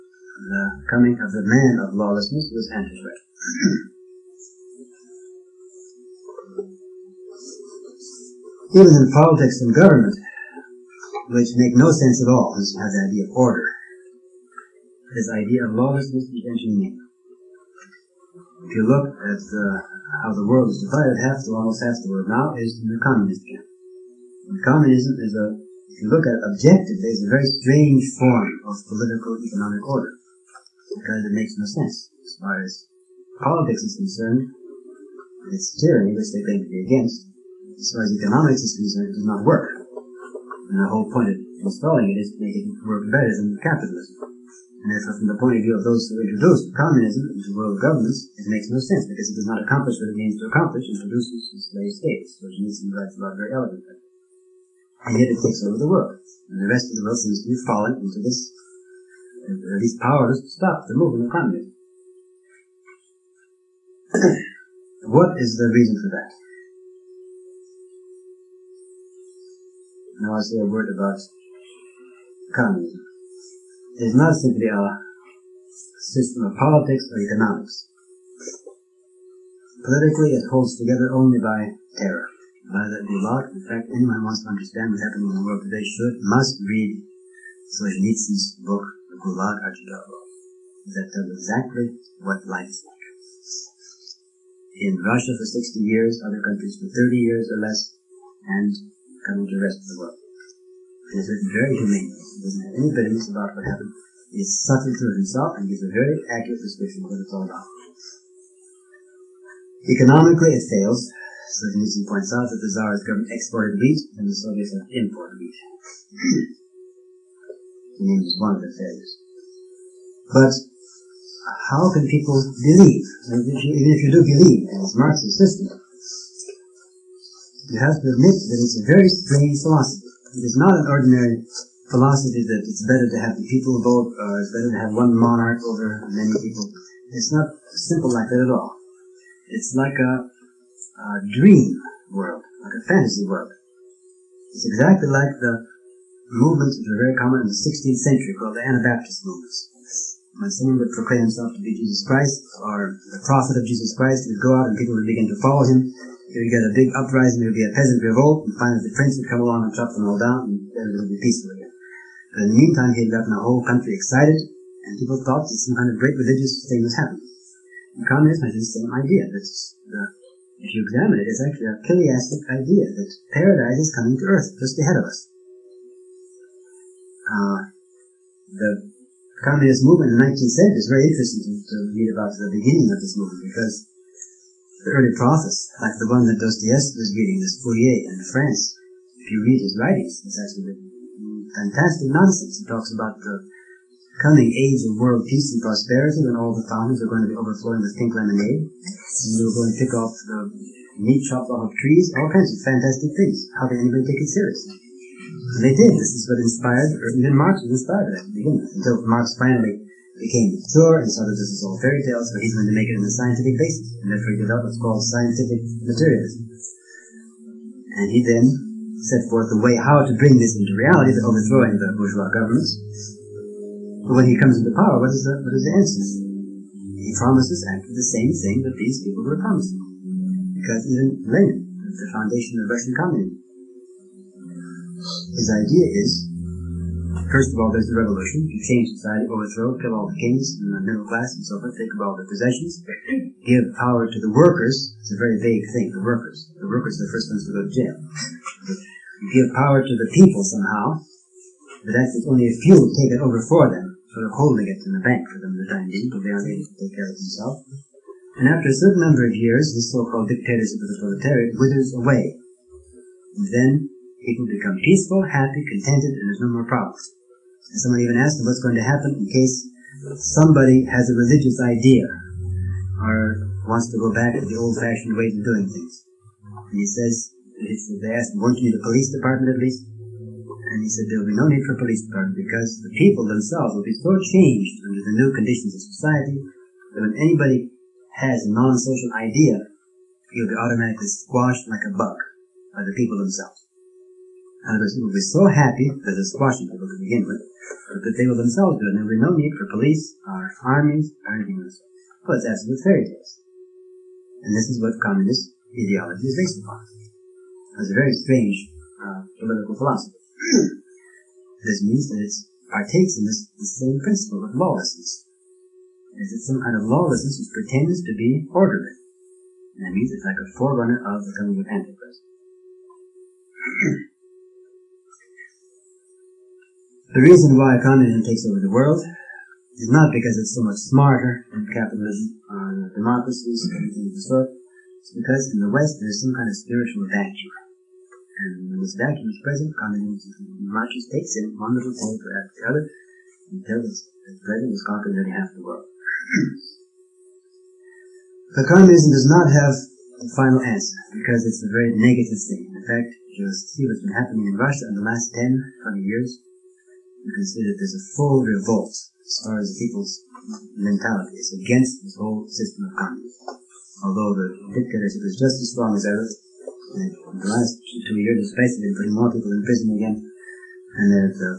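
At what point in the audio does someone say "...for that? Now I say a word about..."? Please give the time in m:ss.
1:06.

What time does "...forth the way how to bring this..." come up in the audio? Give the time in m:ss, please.
3:39.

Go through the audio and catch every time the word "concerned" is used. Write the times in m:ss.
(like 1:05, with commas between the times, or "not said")
0:33, 0:38.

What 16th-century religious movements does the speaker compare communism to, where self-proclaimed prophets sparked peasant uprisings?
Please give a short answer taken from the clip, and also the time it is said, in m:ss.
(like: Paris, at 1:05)
Anabaptist movements, at 2:28.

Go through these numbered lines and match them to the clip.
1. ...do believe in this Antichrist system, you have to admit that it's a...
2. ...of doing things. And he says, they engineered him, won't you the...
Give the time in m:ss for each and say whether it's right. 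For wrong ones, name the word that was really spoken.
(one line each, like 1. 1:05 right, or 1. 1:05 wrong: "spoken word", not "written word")
1. 2:04 wrong: "Marxist", not "Antichrist"
2. 4:35 wrong: "asked", not "engineered".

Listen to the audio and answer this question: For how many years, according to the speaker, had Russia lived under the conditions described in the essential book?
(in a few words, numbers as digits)
60.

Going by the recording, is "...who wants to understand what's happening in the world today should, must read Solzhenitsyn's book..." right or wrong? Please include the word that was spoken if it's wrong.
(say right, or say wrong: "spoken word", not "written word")
right.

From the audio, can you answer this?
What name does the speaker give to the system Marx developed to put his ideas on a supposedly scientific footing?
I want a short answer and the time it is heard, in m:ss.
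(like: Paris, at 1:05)
scientific materialism, at 3:35.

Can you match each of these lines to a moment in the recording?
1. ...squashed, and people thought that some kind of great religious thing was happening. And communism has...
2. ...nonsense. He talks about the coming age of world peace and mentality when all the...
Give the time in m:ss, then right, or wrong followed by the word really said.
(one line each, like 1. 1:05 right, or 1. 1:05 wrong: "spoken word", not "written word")
1. 2:43 wrong: "excited", not "squashed"
2. 3:12 wrong: "prosperity", not "mentality".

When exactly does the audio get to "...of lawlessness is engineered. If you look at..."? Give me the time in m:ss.
0:15.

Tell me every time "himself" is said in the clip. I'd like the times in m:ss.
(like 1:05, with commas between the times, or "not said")
1:45, 2:31.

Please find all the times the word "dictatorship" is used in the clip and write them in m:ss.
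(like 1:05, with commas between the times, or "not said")
4:20, 6:04.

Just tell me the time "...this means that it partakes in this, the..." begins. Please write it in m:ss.
5:11.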